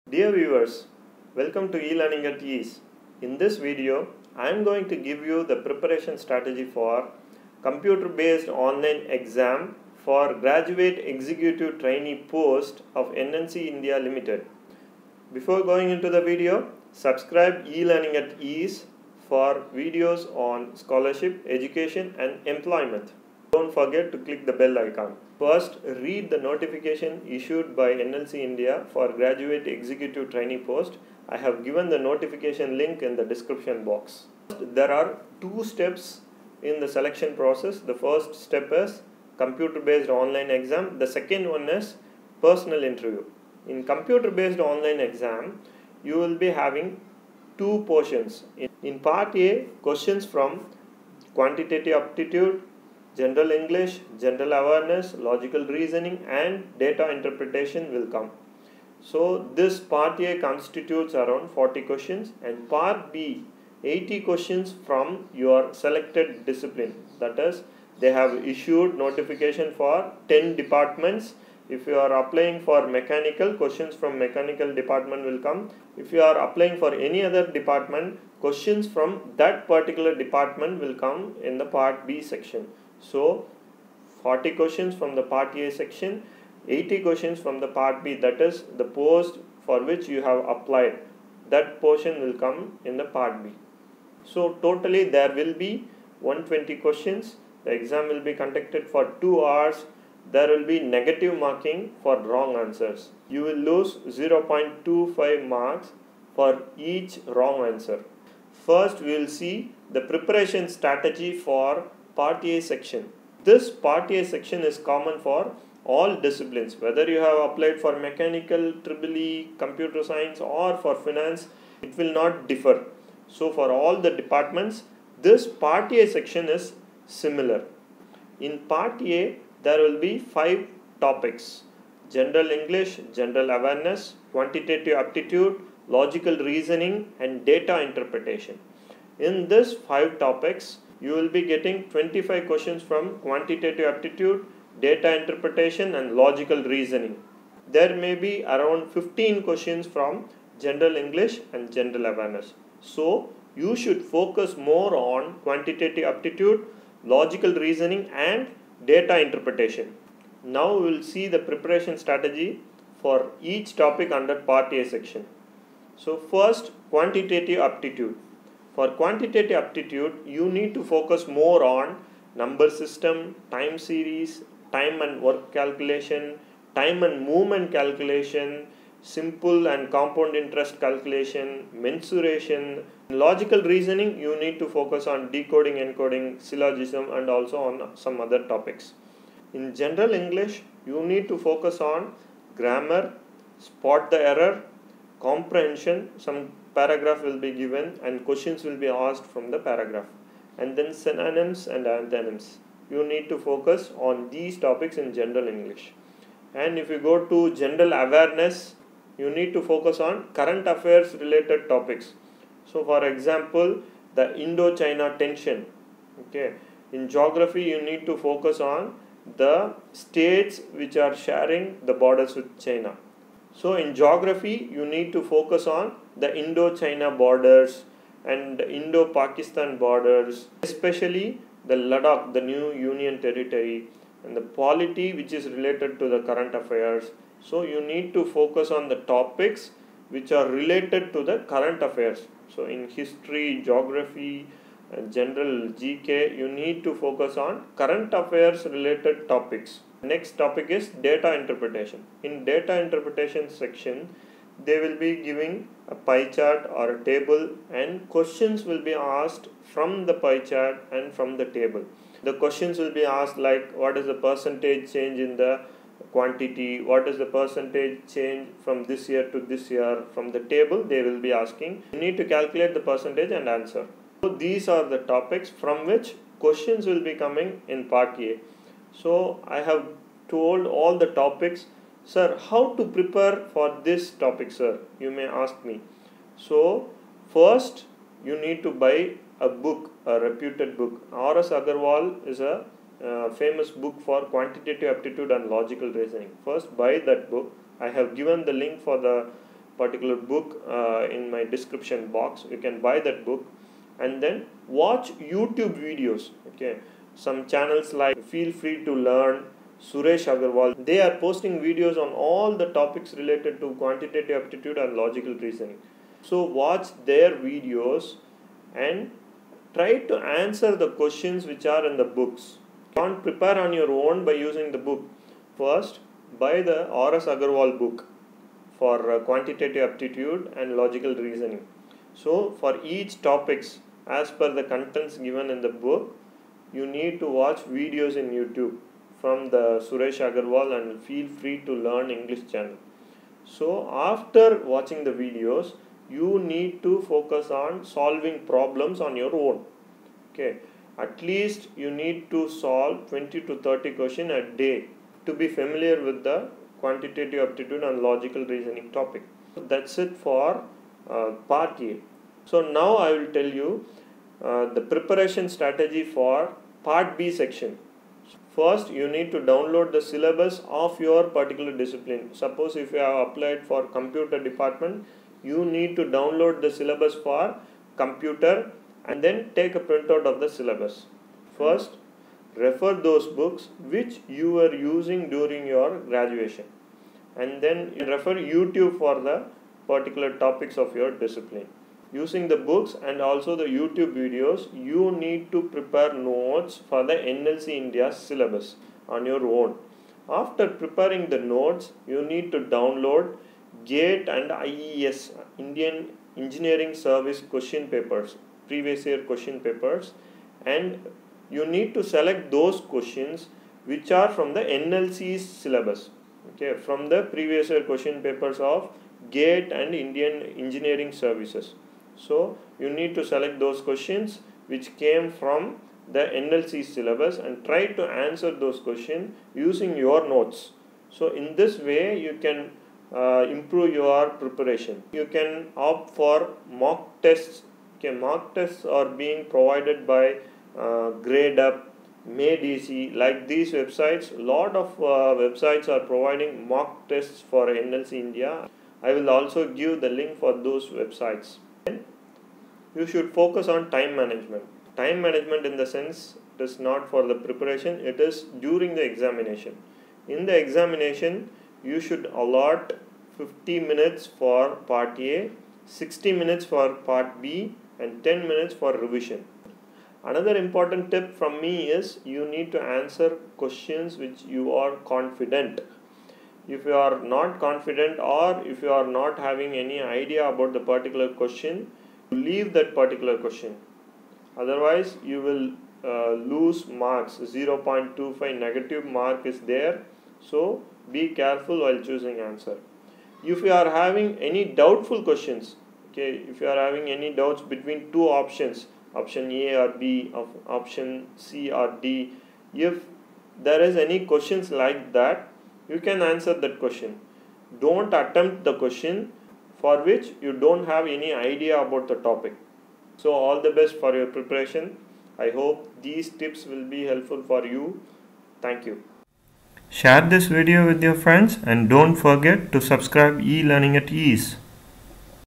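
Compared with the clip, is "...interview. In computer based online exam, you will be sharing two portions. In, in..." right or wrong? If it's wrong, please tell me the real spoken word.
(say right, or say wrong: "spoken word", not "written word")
wrong: "having", not "sharing".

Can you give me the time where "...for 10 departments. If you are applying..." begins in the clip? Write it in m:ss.
1:09.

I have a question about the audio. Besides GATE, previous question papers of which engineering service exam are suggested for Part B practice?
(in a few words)
Indian Engineering Service.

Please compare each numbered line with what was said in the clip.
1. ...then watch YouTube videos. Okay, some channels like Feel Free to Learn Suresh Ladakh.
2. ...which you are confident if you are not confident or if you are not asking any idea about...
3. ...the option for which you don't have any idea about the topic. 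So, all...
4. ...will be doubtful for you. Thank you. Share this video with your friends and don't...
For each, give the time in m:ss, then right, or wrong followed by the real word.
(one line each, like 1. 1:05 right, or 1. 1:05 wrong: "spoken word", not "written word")
1. 5:04 wrong: "Agarwal", not "Ladakh"
2. 7:54 wrong: "having", not "asking"
3. 8:28 wrong: "question", not "option"
4. 8:36 wrong: "helpful", not "doubtful".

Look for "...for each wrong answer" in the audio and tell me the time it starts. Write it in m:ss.
1:46.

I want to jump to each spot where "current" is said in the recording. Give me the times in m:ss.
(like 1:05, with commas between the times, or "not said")
3:30, 3:56, 4:01, 4:07.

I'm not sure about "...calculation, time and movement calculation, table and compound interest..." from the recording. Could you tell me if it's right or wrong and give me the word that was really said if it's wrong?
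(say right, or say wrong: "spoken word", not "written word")
wrong: "simple", not "table".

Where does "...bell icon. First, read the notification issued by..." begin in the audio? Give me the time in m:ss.
0:24.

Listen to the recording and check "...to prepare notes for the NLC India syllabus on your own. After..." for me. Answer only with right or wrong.
right.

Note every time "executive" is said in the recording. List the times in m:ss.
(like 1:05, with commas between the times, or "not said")
0:11, 0:29.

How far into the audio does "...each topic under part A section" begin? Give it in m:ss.
2:43.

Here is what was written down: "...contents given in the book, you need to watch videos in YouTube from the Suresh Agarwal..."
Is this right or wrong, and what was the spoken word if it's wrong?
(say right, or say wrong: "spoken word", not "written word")
right.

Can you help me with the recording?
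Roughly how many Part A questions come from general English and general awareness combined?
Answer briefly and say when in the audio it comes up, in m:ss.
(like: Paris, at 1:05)
15, at 2:28.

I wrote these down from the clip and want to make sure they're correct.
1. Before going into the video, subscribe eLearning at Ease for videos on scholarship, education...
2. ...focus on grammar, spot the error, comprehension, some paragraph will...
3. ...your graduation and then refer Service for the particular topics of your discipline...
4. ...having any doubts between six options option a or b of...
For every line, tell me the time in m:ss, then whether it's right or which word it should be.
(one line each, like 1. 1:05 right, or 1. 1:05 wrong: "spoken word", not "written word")
1. 0:15 right
2. 3:11 right
3. 6:25 wrong: "YouTube", not "Service"
4. 8:16 wrong: "two", not "six".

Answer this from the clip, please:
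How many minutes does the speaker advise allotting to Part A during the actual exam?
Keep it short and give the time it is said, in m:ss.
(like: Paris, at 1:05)
50 minutes, at 7:43.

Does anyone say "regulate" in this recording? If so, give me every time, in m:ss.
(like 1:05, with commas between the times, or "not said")
not said.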